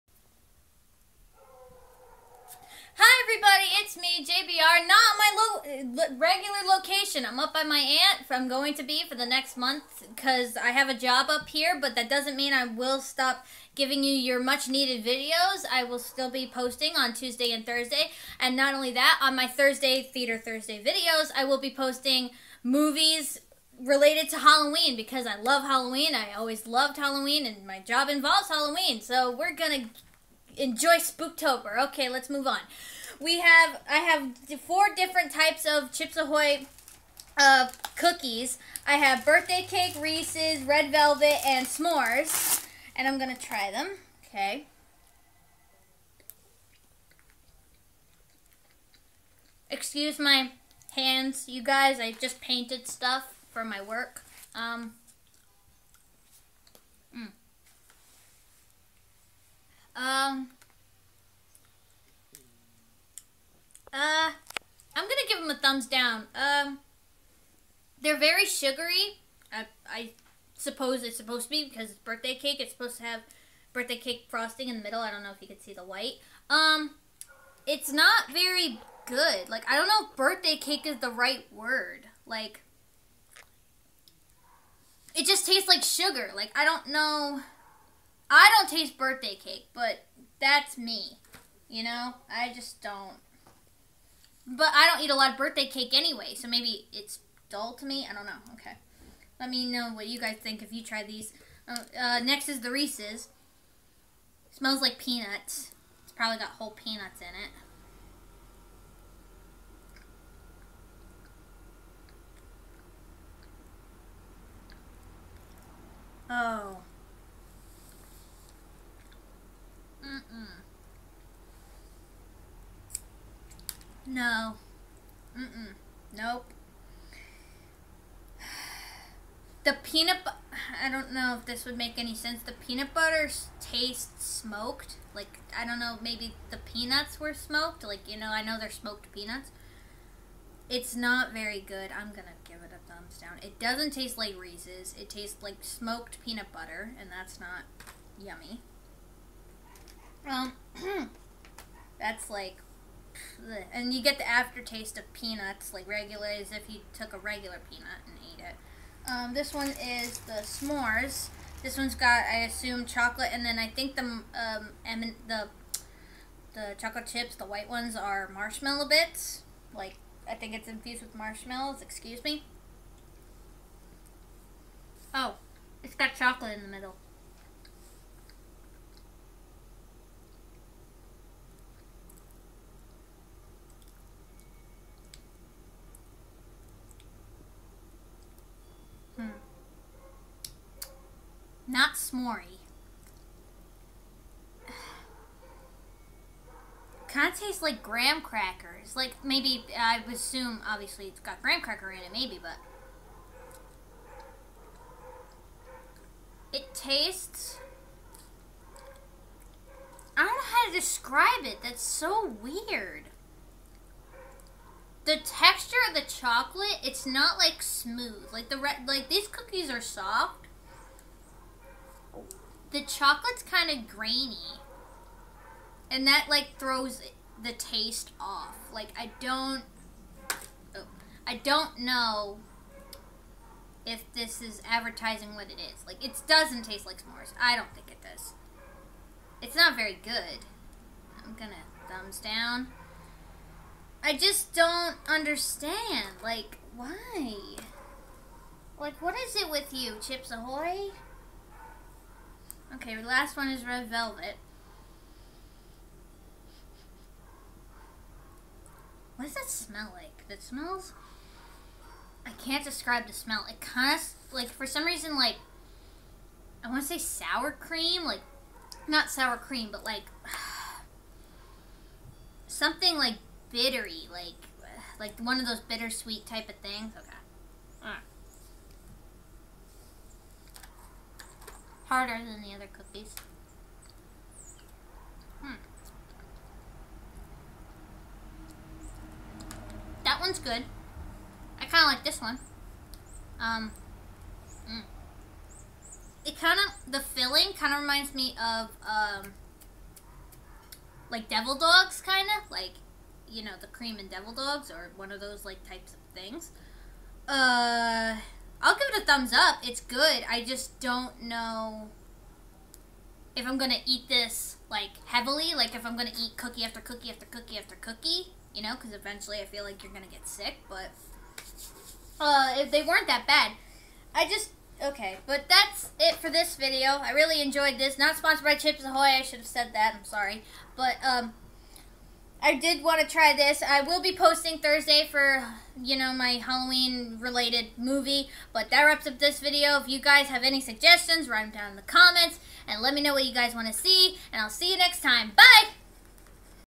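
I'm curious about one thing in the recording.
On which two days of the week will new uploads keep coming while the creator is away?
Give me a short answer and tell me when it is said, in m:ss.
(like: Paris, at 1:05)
Tuesday and Thursday, at 0:17.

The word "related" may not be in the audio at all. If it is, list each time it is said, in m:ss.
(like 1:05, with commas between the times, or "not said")
0:23, 5:37.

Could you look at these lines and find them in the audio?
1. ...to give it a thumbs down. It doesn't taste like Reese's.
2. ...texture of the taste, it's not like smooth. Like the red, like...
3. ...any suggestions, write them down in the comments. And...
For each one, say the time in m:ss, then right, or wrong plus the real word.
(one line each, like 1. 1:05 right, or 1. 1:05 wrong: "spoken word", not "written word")
1. 2:22 right
2. 3:35 wrong: "chocolate", not "taste"
3. 5:40 right.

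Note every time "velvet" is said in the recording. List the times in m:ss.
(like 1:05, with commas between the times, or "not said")
0:40, 4:13.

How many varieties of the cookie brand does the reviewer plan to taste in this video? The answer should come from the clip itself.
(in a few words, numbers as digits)
4.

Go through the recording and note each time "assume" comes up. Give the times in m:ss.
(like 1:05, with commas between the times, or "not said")
2:42, 3:20.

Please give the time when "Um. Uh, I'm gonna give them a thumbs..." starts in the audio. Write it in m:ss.
0:59.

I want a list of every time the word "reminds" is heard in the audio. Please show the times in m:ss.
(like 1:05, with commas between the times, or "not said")
4:57.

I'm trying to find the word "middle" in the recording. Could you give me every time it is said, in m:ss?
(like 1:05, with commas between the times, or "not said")
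1:14, 2:56.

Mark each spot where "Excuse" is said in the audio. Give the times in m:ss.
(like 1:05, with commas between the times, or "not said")
0:49, 2:51.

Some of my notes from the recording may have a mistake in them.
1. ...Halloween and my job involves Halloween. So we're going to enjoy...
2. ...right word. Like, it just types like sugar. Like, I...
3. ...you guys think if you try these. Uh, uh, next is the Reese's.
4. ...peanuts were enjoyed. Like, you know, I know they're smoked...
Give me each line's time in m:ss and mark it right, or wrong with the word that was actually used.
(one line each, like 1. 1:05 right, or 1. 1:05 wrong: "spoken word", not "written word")
1. 0:26 right
2. 1:21 wrong: "tastes", not "types"
3. 1:40 right
4. 2:16 wrong: "smoked", not "enjoyed".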